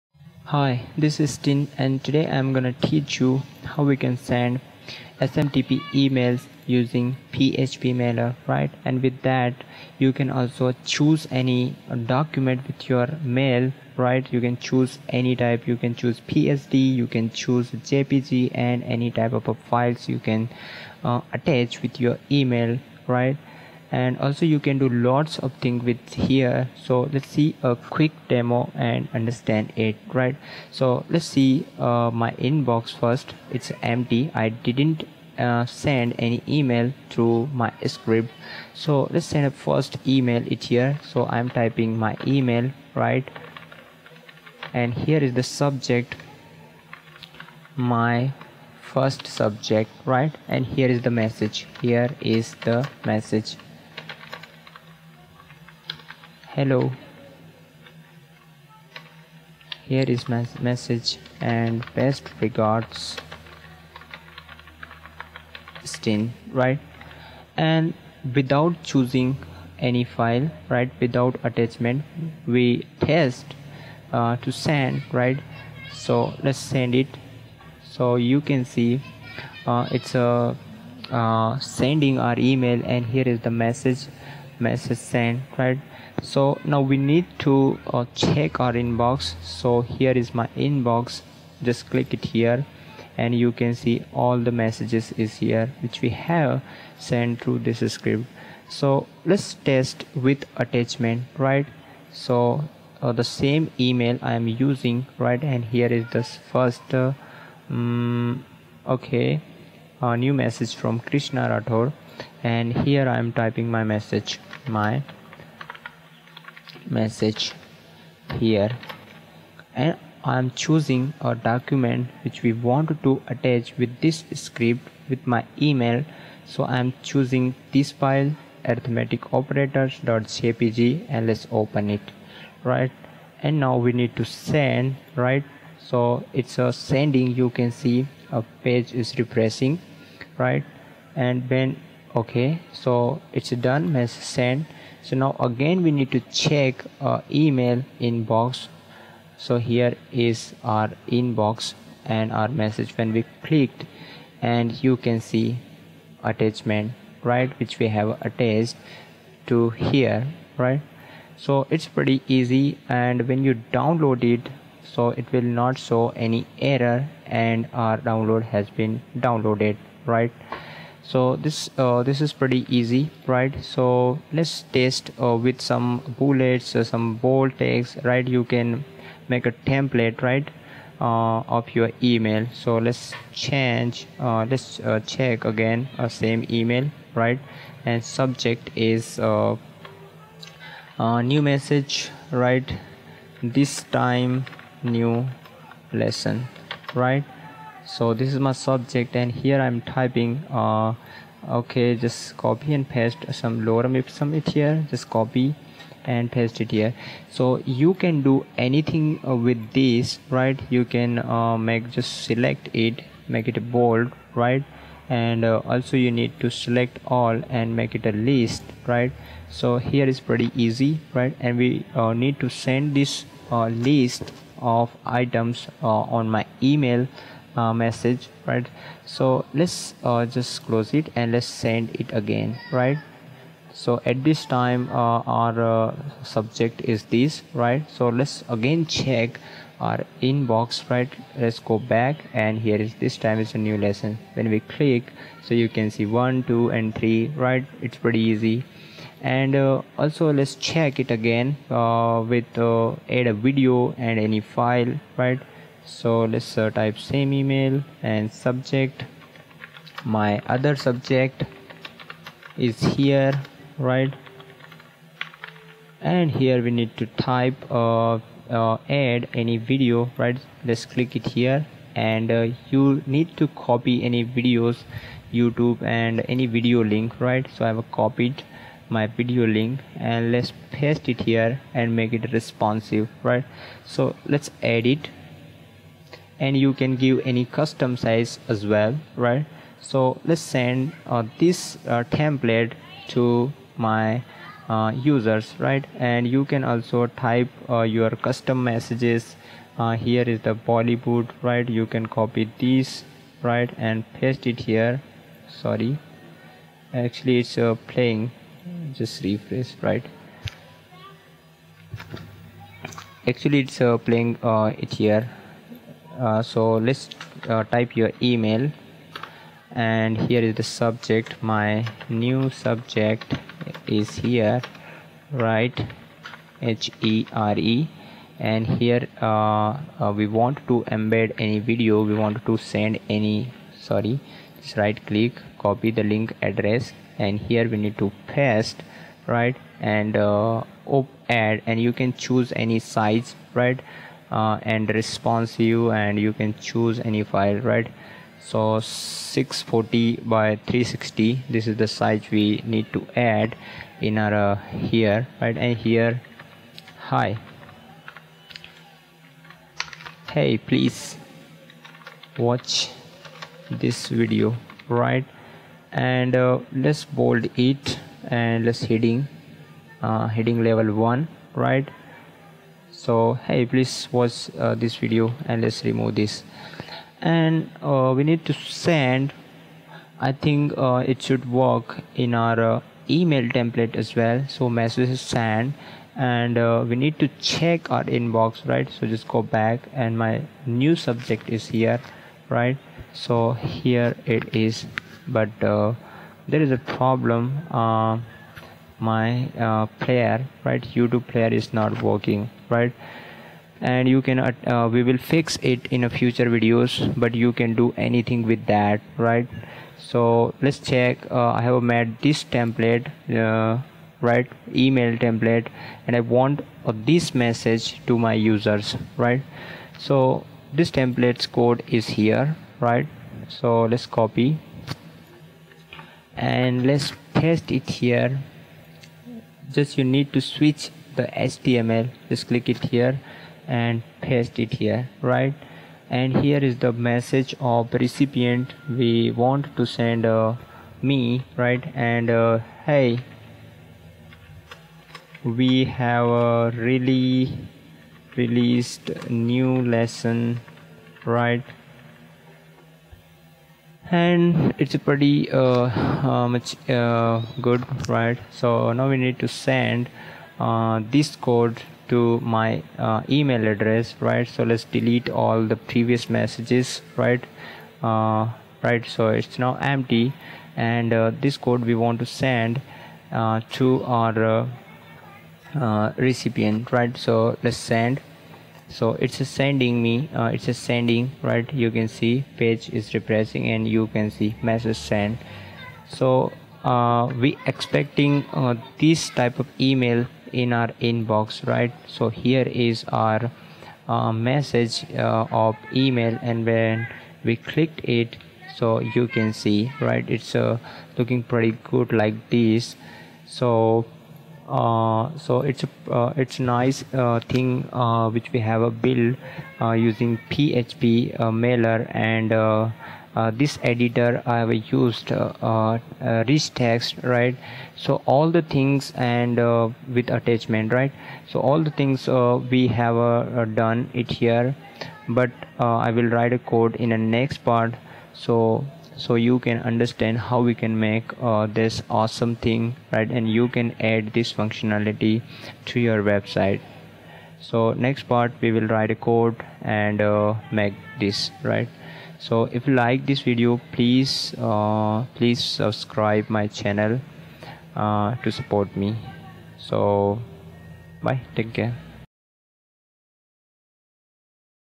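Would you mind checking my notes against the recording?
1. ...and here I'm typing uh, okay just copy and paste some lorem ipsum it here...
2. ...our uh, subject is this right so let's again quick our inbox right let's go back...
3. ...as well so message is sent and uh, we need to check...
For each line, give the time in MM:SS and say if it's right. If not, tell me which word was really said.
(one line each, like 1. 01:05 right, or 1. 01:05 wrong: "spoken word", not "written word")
1. 03:19 right
2. 03:55 wrong: "check", not "quick"
3. 06:23 right.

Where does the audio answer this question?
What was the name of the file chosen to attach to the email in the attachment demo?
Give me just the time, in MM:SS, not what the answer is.
02:08.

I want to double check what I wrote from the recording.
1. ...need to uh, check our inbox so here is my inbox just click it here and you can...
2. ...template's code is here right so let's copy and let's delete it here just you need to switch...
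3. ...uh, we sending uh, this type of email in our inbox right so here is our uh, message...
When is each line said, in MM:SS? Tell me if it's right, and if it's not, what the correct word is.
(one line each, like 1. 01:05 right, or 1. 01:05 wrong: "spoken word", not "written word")
1. 01:26 right
2. 07:00 wrong: "paste", not "delete"
3. 08:06 wrong: "expecting", not "sending".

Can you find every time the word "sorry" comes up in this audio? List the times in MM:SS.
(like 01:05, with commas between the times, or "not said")
05:05, 05:33.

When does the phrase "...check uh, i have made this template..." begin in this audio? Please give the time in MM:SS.
06:50.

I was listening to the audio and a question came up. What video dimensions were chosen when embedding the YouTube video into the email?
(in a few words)
640 by 360.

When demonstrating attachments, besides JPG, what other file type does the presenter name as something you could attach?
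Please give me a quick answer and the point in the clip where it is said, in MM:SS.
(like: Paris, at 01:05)
PSD, at 00:16.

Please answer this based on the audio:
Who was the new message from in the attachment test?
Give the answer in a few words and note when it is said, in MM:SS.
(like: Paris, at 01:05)
Krishna Rathore, at 01:50.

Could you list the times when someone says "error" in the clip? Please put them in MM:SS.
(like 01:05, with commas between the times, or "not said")
02:46.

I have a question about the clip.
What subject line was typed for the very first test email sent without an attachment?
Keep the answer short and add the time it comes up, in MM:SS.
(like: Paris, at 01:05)
my first subject, at 00:47.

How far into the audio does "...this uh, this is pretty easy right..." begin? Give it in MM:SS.
02:51.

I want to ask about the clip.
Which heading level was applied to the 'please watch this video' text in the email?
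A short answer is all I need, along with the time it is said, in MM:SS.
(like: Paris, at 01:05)
heading level 1, at 06:10.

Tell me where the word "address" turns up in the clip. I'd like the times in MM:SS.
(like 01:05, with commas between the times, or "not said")
05:36, 07:43.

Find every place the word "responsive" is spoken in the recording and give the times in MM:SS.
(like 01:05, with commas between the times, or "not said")
04:42, 05:44.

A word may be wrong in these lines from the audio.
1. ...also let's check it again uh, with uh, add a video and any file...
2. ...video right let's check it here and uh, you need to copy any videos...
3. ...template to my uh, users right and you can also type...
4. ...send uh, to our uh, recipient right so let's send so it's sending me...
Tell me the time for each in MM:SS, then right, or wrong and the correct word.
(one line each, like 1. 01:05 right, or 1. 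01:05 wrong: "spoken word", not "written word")
1. 04:09 right
2. 04:29 wrong: "click", not "check"
3. 04:52 right
4. 07:52 right.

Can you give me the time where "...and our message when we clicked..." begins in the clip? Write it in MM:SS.
02:32.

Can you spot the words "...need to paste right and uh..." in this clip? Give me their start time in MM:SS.
05:37.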